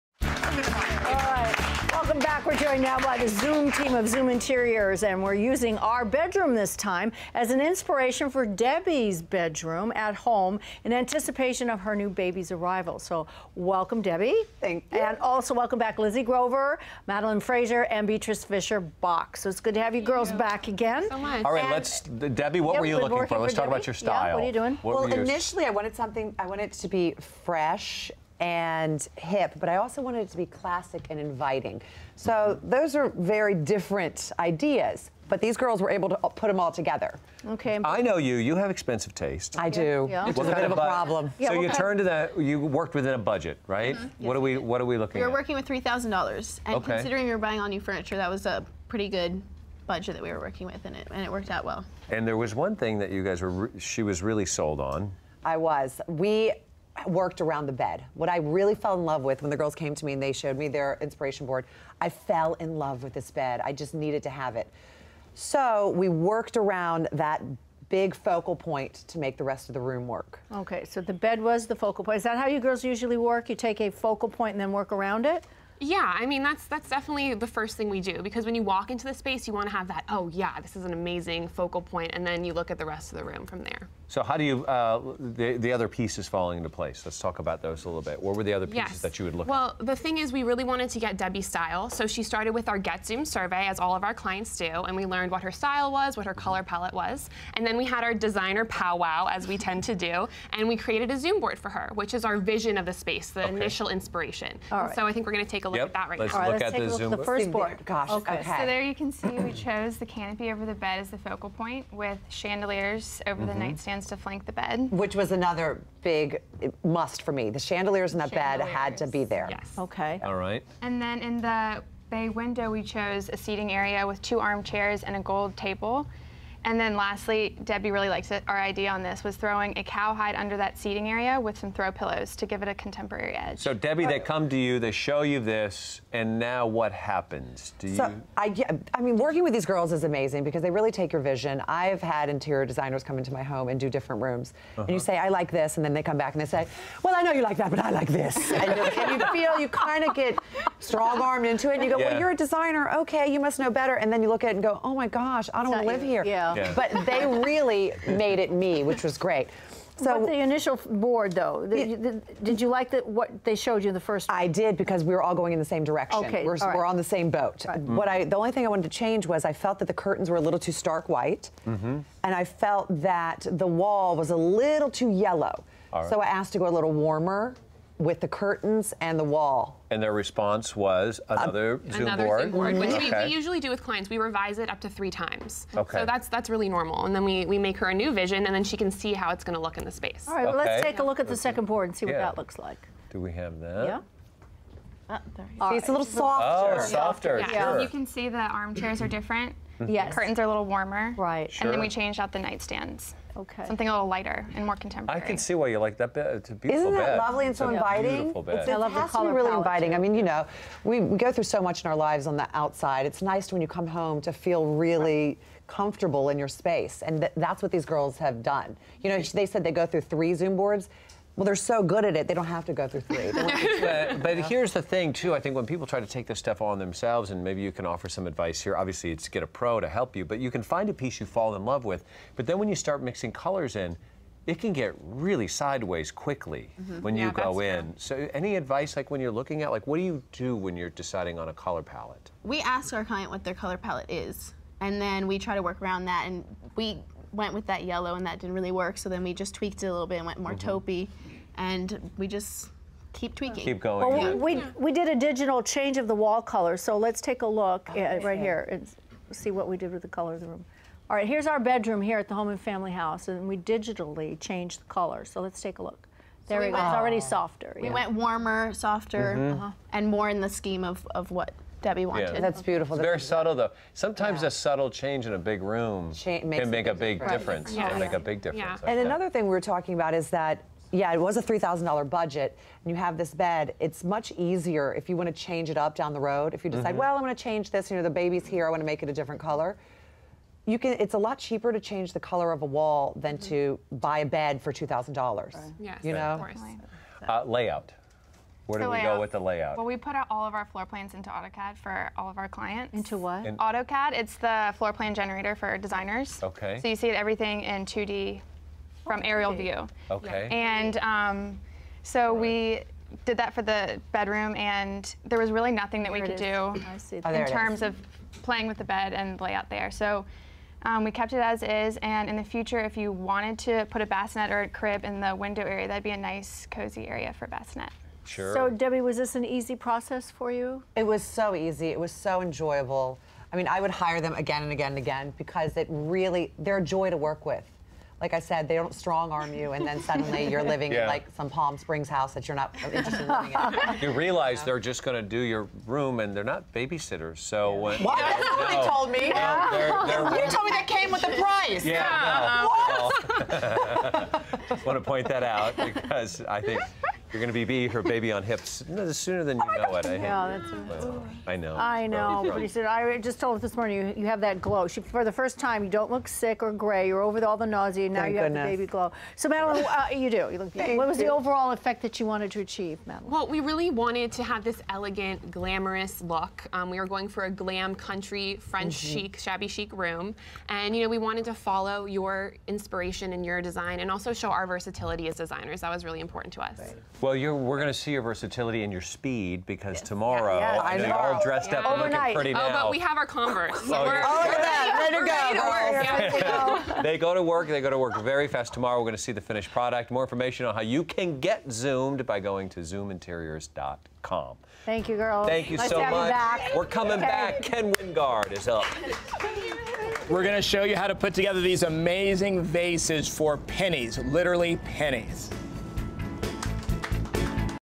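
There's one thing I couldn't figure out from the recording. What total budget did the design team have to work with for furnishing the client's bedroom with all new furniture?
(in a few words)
$3,000.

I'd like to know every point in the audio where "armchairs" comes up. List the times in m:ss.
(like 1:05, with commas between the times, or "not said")
2:04, 3:18.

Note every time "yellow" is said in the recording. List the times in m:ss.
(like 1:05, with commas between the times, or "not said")
2:55, 4:07.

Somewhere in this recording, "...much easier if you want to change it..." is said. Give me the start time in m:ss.
4:44.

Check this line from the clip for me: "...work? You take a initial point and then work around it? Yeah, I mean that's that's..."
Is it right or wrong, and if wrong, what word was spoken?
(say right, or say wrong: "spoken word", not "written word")
wrong: "focal", not "initial".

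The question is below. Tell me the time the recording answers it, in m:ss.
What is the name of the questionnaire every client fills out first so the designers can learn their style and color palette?
1:32.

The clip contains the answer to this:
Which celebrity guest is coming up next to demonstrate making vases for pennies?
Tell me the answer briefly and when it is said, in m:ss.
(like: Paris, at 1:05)
Ken Wingard, at 6:47.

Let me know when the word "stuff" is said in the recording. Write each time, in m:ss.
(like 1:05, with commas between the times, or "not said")
3:46.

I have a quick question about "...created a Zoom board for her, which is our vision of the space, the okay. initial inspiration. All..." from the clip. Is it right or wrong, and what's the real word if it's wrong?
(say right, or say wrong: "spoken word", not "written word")
right.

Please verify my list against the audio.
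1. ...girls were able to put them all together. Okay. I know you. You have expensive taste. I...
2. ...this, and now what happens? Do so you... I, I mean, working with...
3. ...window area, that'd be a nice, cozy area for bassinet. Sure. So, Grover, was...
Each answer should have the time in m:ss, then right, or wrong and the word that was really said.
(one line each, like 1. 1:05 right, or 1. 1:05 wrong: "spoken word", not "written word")
1. 0:35 right
2. 2:15 right
3. 5:25 wrong: "Debbie", not "Grover".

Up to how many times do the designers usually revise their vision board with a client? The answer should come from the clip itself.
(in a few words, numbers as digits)
3.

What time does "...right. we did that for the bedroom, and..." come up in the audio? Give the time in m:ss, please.
5:12.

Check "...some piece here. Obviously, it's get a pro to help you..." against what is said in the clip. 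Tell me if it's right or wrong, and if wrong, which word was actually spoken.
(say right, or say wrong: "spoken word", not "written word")
wrong: "advice", not "piece".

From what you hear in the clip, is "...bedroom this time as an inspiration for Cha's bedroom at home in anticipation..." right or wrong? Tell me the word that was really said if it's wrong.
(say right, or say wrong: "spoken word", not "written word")
wrong: "Debbie", not "Cha".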